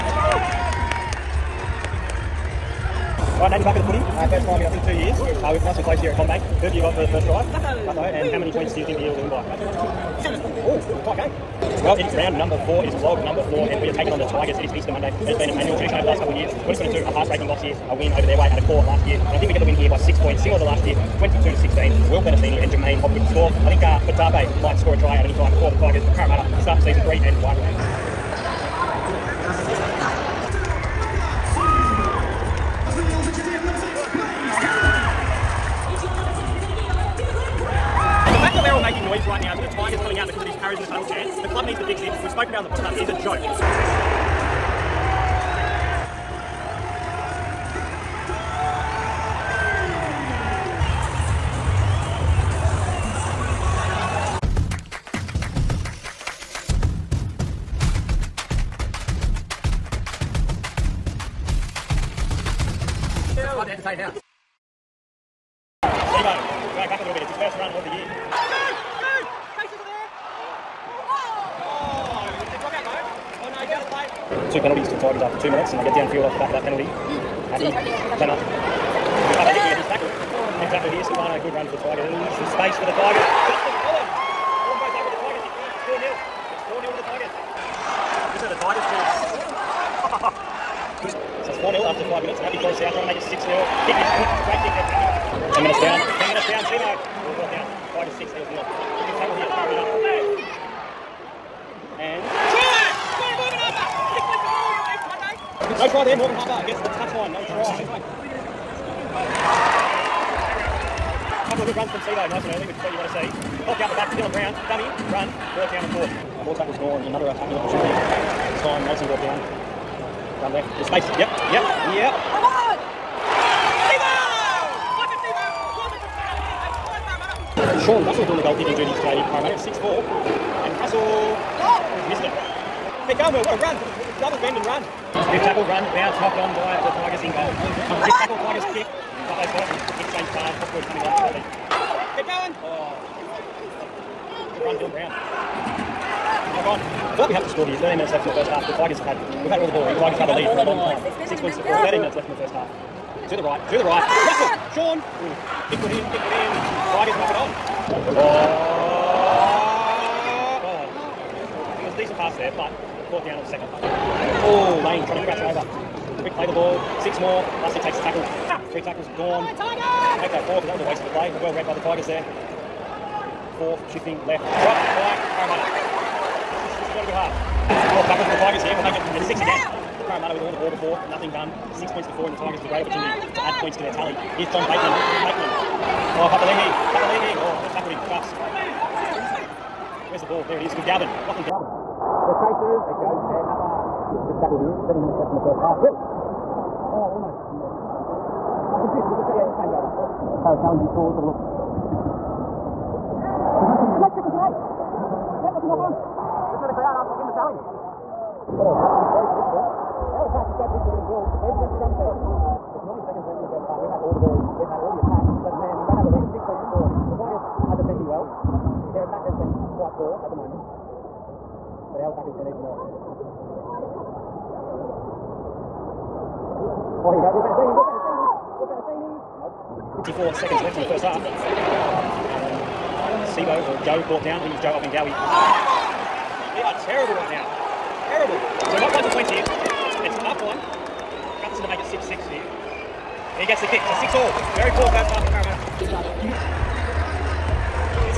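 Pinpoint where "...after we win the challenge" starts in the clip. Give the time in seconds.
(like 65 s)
206 s.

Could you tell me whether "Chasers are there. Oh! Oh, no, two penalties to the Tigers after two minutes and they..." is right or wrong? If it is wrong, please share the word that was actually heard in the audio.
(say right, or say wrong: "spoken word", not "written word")
right.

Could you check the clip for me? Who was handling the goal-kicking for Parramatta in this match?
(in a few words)
Sean Russell.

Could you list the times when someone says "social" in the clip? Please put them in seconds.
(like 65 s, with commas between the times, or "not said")
not said.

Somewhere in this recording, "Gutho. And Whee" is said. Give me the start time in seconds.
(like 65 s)
7 s.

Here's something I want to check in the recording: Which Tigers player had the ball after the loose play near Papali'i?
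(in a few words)
Lachlan Galvin.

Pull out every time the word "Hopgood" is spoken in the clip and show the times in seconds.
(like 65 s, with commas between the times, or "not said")
23 s, 140 s.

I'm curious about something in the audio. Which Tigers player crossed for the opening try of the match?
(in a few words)
Justin Olam.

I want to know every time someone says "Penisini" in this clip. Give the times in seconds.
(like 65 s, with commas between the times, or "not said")
22 s, 227 s.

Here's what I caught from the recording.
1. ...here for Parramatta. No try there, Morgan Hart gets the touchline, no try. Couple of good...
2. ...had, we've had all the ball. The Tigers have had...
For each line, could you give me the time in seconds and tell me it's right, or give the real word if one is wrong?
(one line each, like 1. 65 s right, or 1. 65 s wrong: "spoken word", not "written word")
1. 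99 s right
2. 149 s right.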